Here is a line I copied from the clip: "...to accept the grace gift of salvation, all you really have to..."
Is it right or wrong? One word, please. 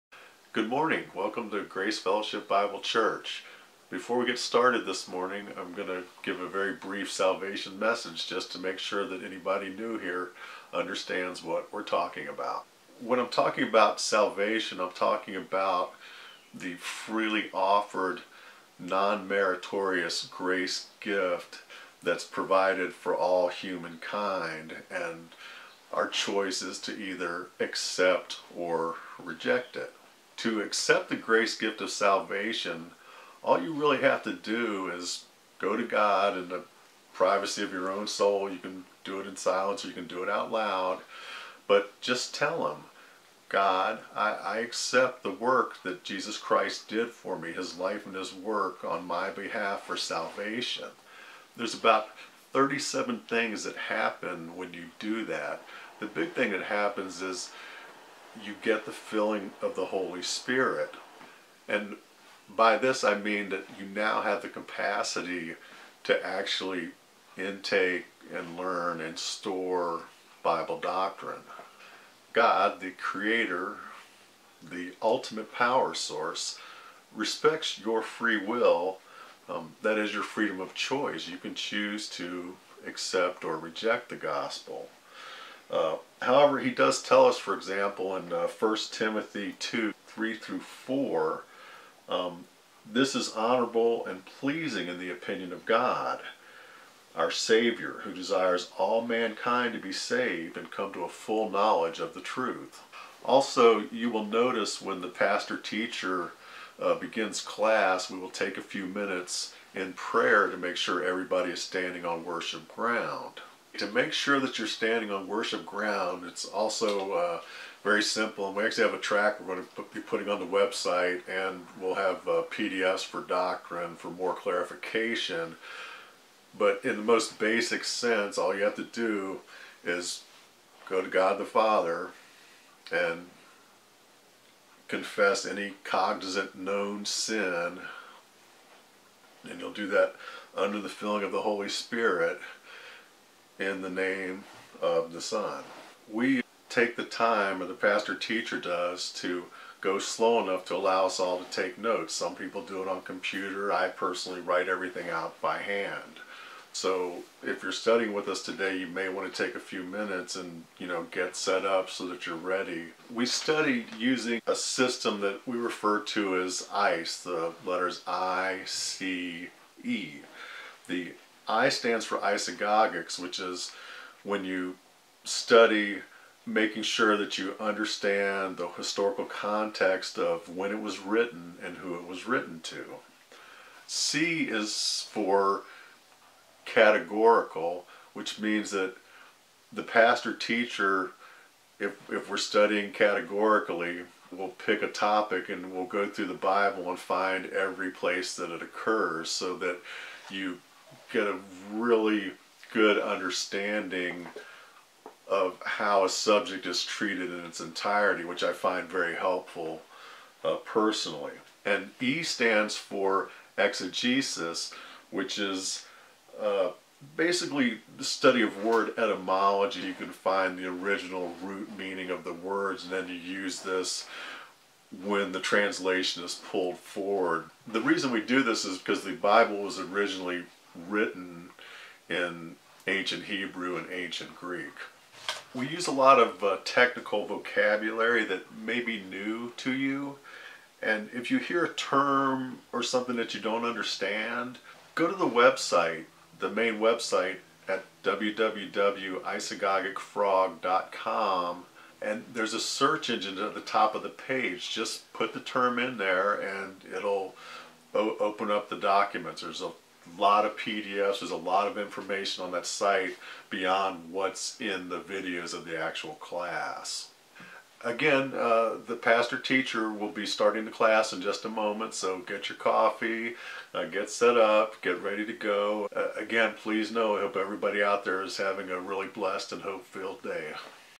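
right.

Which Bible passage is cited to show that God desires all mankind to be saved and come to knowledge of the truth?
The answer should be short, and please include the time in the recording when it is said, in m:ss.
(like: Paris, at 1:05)
1 Timothy 2:3-4, at 1:28.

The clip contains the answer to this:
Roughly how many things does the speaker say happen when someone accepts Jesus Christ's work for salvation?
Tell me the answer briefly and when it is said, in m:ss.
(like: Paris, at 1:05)
37, at 0:52.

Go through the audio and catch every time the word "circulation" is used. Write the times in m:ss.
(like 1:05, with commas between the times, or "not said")
not said.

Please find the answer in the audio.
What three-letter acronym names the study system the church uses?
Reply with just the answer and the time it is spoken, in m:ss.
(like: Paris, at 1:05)
ICE, at 2:46.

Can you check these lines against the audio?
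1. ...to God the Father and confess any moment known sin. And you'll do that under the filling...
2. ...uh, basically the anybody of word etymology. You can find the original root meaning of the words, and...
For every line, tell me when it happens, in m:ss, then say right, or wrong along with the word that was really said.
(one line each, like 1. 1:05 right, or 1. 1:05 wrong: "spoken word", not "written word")
1. 2:11 wrong: "cognizant", not "moment"
2. 3:36 wrong: "study", not "anybody".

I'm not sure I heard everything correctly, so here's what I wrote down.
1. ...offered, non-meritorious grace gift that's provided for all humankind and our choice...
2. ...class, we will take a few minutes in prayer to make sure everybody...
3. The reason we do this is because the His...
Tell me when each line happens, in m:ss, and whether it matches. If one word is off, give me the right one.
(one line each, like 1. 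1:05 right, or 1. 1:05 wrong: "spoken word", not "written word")
1. 0:17 right
2. 1:47 right
3. 3:47 wrong: "Bible", not "His".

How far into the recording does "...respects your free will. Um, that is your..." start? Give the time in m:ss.
1:17.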